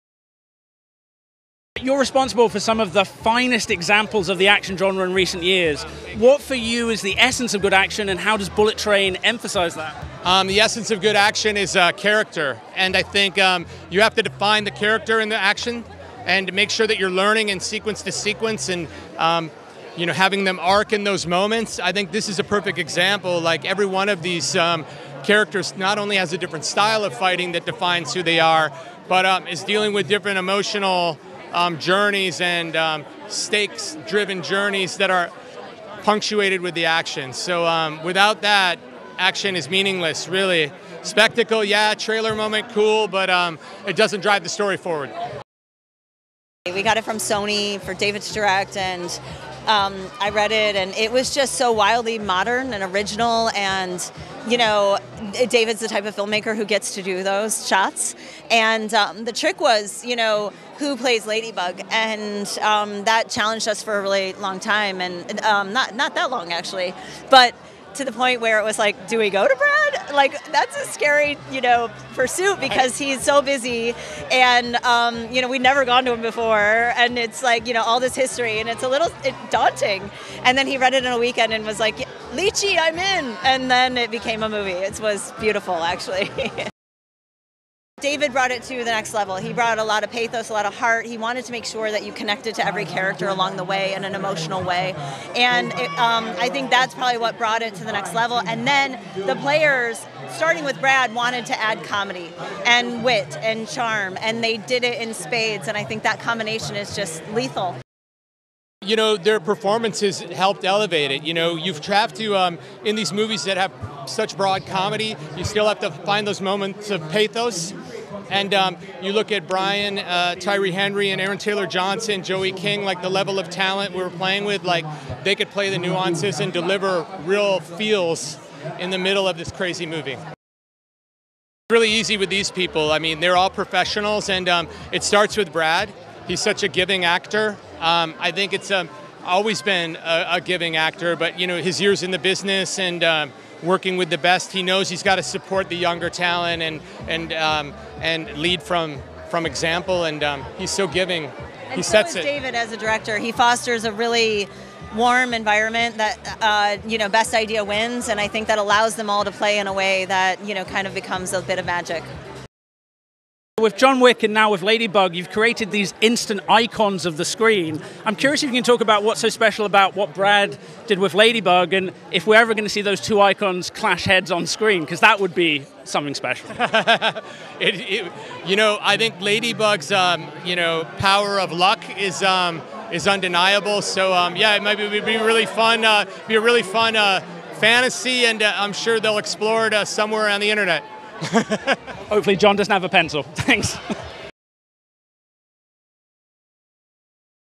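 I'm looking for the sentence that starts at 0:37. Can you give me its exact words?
So um, without that, action is meaningless, really.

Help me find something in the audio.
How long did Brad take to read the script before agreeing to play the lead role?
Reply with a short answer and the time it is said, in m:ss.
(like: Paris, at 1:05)
A weekend, at 1:21.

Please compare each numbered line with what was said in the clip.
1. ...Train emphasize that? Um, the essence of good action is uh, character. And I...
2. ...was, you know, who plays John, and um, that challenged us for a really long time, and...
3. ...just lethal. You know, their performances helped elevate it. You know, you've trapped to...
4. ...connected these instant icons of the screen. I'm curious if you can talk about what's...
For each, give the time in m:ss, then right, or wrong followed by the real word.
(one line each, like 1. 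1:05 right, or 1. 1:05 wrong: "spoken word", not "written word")
1. 0:08 right
2. 0:59 wrong: "Ladybug", not "John"
3. 1:46 right
4. 2:45 wrong: "created", not "connected".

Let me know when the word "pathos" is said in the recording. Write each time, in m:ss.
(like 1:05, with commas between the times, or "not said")
1:30, 1:57.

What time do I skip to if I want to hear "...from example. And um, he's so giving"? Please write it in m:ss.
2:29.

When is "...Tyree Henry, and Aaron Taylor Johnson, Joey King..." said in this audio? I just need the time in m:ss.
2:00.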